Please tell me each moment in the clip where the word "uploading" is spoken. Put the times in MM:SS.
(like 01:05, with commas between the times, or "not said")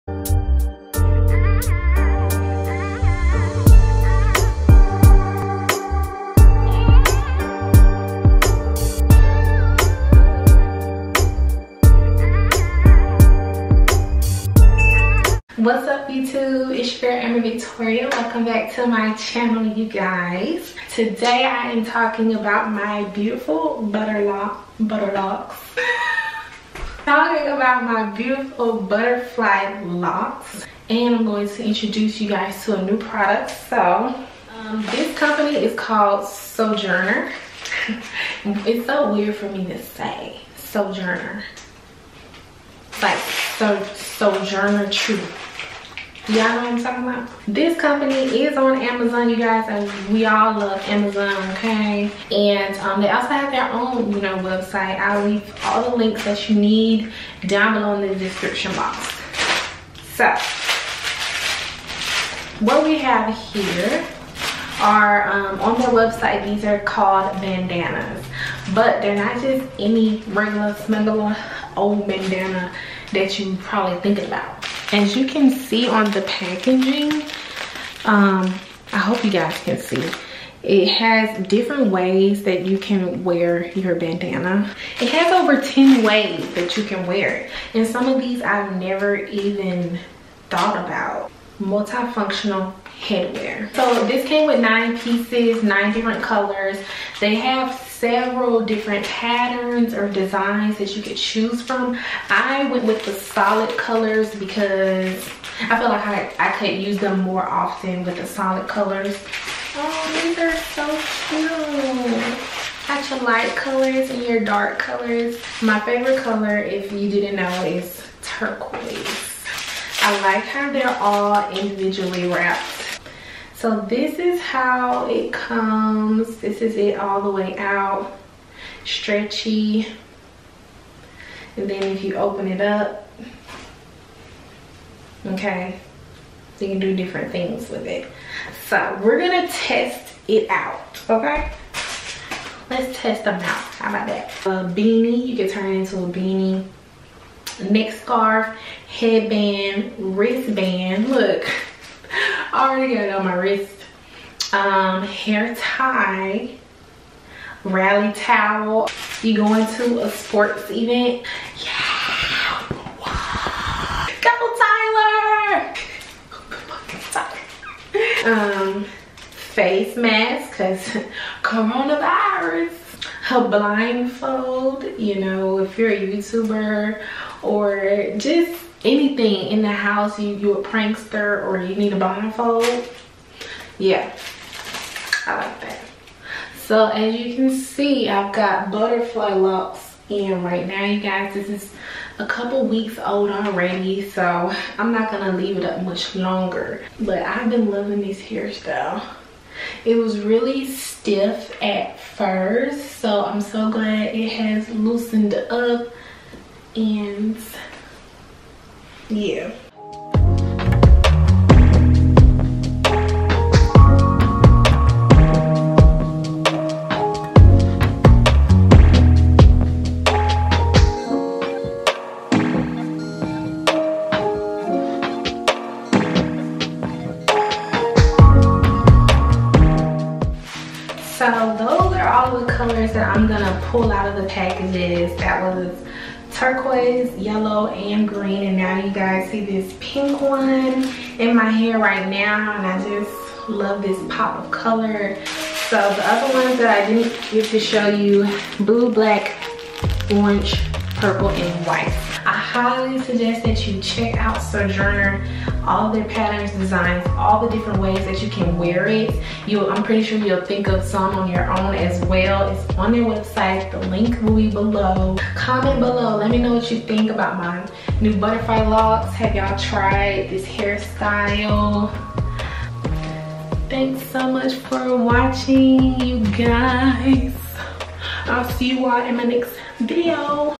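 not said.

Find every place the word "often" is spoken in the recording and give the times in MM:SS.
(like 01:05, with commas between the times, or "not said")
01:47.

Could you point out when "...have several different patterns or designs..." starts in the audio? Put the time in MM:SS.
01:37.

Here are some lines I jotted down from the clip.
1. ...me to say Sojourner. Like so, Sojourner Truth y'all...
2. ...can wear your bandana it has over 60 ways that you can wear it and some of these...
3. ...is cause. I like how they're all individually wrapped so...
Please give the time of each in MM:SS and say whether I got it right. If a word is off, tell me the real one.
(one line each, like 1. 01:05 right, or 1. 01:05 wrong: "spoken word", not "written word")
1. 00:39 right
2. 01:22 wrong: "10", not "60"
3. 01:57 wrong: "turquoise", not "cause".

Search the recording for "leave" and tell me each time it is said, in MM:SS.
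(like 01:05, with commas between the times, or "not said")
00:55, 03:15.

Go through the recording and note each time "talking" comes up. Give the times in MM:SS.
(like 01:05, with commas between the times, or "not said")
00:21, 00:27, 00:46.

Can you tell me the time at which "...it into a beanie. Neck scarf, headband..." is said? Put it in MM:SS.
02:25.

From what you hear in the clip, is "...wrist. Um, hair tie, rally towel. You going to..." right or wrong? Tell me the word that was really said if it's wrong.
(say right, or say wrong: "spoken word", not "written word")
right.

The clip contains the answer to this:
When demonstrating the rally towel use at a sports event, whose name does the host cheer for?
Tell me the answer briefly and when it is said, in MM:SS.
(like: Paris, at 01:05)
Tyler, at 02:44.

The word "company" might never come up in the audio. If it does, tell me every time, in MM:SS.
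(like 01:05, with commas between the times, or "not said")
00:35, 00:47.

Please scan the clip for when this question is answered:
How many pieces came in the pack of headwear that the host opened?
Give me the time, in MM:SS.
01:34.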